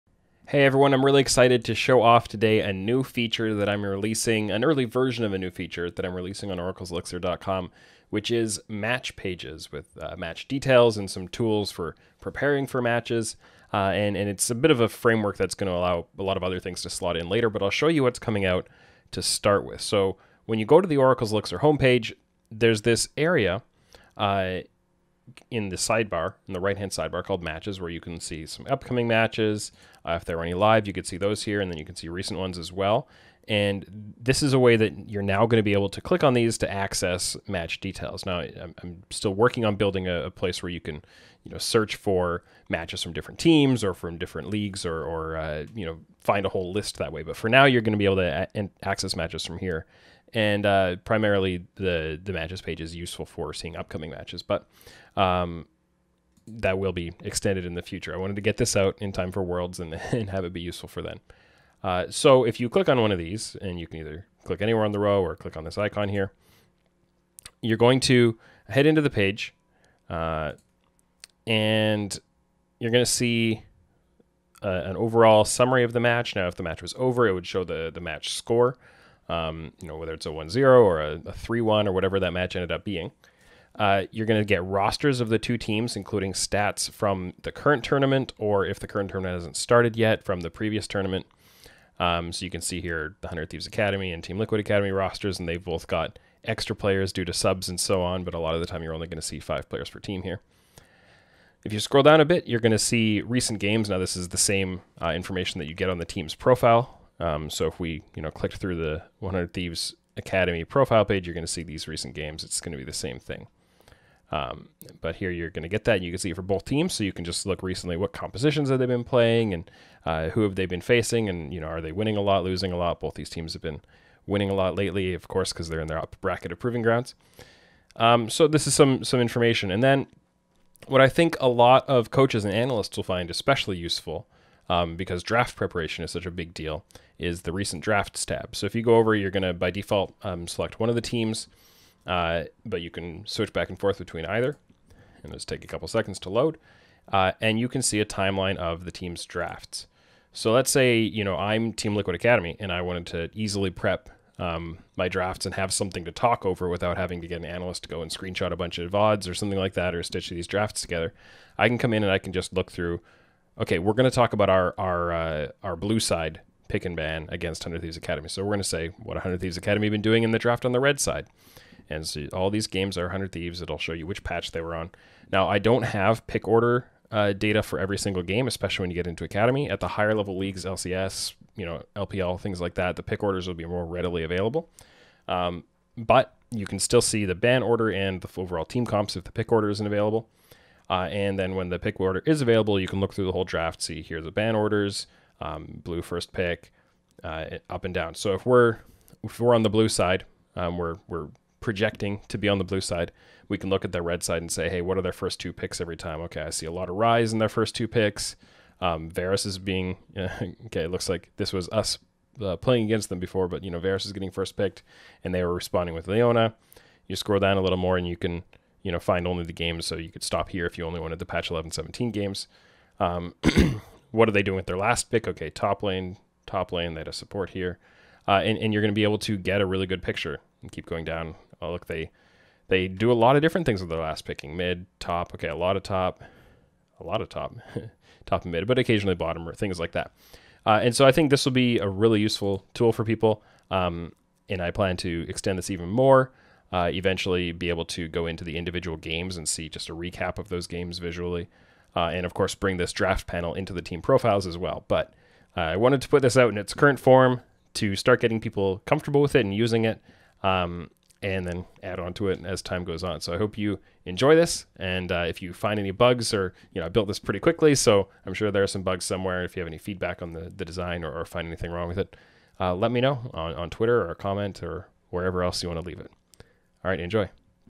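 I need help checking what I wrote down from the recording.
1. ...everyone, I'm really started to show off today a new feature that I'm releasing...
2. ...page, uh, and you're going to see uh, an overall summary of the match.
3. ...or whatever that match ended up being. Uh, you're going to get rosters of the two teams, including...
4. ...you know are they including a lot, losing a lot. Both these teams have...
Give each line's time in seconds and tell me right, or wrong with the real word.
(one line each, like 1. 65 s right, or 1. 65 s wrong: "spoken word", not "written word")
1. 0 s wrong: "excited", not "started"
2. 69 s right
3. 81 s right
4. 121 s wrong: "winning", not "including".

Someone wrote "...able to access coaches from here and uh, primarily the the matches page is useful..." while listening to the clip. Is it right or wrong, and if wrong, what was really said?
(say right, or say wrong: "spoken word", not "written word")
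wrong: "matches", not "coaches".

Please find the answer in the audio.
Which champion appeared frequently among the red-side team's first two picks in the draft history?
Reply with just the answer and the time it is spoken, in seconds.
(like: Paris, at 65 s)
Rise, at 206 s.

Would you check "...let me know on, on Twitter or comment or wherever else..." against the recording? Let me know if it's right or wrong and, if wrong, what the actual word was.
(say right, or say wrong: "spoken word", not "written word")
right.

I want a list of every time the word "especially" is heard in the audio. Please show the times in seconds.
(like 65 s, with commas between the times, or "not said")
133 s, 178 s.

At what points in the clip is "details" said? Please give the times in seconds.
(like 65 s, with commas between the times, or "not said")
10 s, 37 s.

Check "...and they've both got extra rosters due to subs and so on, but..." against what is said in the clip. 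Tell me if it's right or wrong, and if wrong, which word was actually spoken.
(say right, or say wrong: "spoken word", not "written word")
wrong: "players", not "rosters".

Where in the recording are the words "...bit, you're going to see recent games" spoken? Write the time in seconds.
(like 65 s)
102 s.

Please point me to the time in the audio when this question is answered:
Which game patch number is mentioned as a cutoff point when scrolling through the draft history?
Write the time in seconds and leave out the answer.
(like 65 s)
221 s.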